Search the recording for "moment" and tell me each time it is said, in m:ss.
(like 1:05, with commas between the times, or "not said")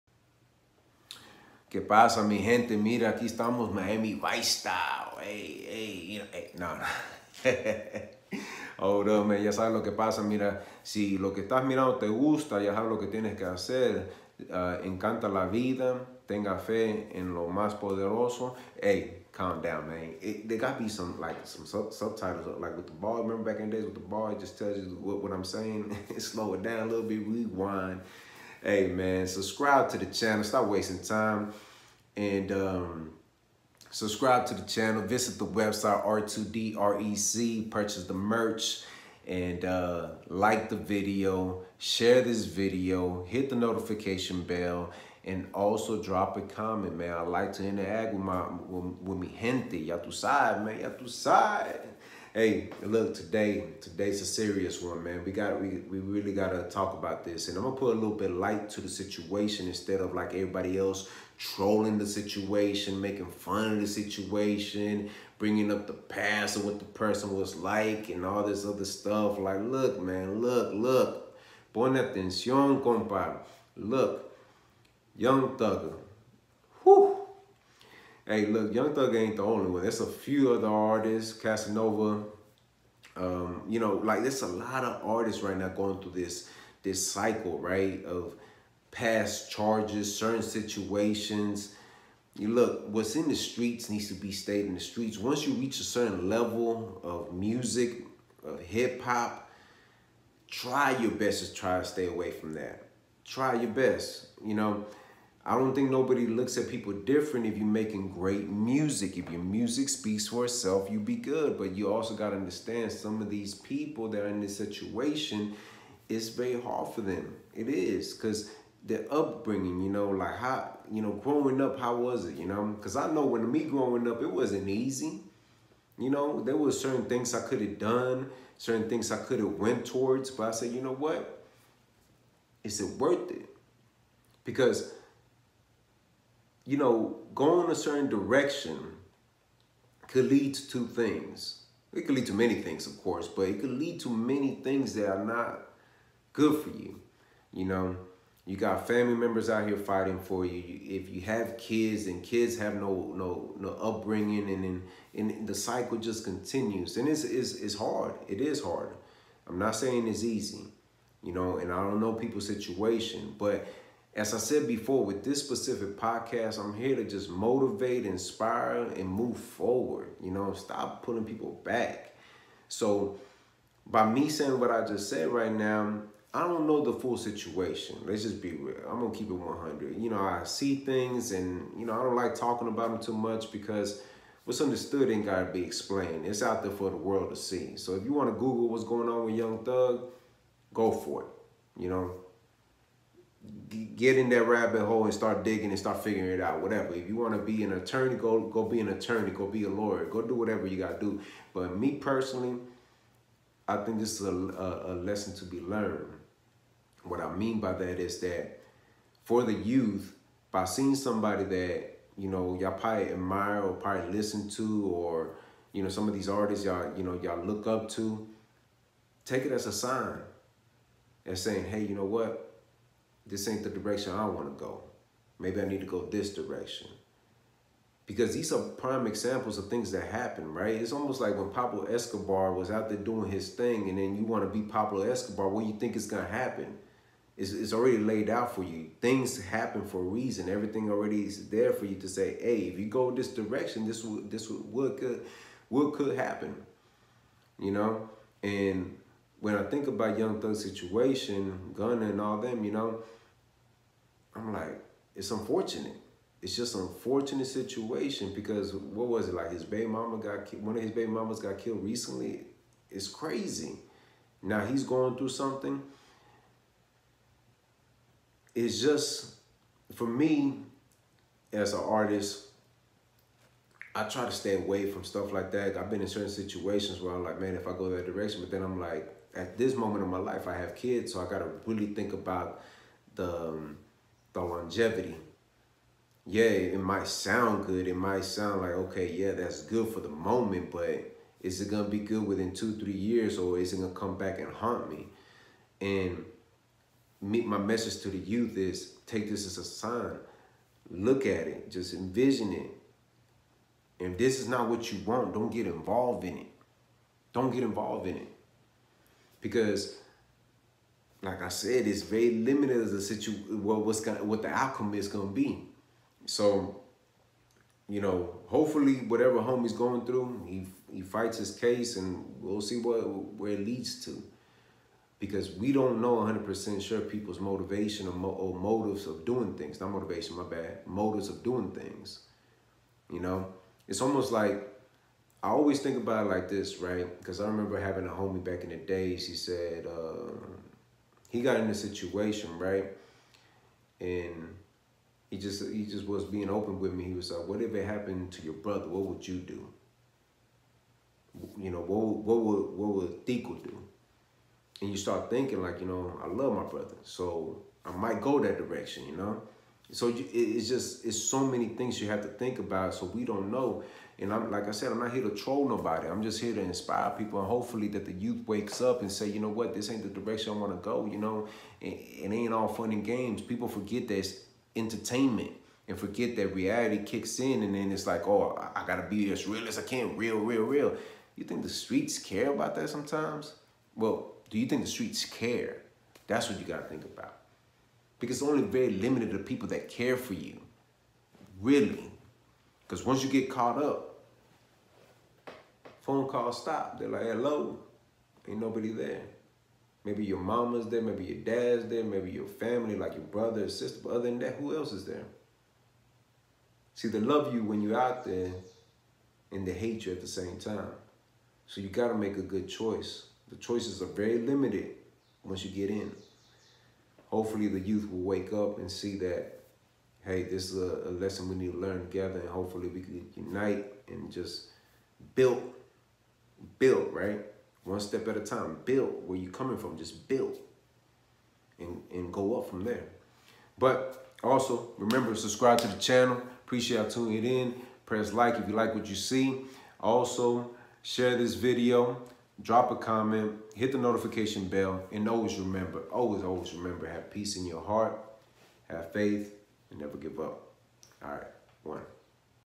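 4:39, 4:50.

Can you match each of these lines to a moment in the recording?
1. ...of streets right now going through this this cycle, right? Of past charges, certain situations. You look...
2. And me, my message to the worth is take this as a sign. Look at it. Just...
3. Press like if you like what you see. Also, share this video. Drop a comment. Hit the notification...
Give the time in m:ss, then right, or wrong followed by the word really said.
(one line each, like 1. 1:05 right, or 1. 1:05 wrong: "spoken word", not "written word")
1. 1:24 wrong: "artists", not "streets"
2. 4:55 wrong: "youth", not "worth"
3. 7:18 right.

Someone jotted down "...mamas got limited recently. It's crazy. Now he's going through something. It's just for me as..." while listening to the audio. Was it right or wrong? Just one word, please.
wrong.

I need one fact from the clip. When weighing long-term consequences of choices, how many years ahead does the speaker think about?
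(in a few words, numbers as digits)
2 or 3 years.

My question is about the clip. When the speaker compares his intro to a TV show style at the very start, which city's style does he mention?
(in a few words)
Miami.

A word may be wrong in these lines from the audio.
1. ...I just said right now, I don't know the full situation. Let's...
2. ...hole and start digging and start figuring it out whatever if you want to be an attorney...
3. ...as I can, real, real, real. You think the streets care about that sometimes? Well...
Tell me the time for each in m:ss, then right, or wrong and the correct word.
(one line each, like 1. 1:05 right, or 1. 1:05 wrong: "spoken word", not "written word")
1. 2:54 right
2. 3:14 right
3. 6:19 right.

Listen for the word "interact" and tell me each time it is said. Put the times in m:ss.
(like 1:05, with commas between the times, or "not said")
0:47.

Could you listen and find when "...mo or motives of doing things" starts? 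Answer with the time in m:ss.
5:28.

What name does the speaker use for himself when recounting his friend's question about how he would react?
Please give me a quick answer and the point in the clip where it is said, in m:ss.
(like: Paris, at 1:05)
TiCO, at 5:53.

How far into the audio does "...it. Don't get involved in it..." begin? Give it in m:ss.
5:06.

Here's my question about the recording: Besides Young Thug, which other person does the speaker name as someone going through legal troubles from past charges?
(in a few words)
Casanova.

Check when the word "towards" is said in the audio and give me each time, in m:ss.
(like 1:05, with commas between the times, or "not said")
2:09.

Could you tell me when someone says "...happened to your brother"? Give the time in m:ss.
5:47.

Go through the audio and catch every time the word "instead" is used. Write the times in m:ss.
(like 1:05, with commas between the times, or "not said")
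0:59.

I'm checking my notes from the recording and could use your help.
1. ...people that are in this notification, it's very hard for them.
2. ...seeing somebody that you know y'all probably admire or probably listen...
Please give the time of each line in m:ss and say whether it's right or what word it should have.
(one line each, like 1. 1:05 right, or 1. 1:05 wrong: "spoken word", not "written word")
1. 1:53 wrong: "situation", not "notification"
2. 3:30 right.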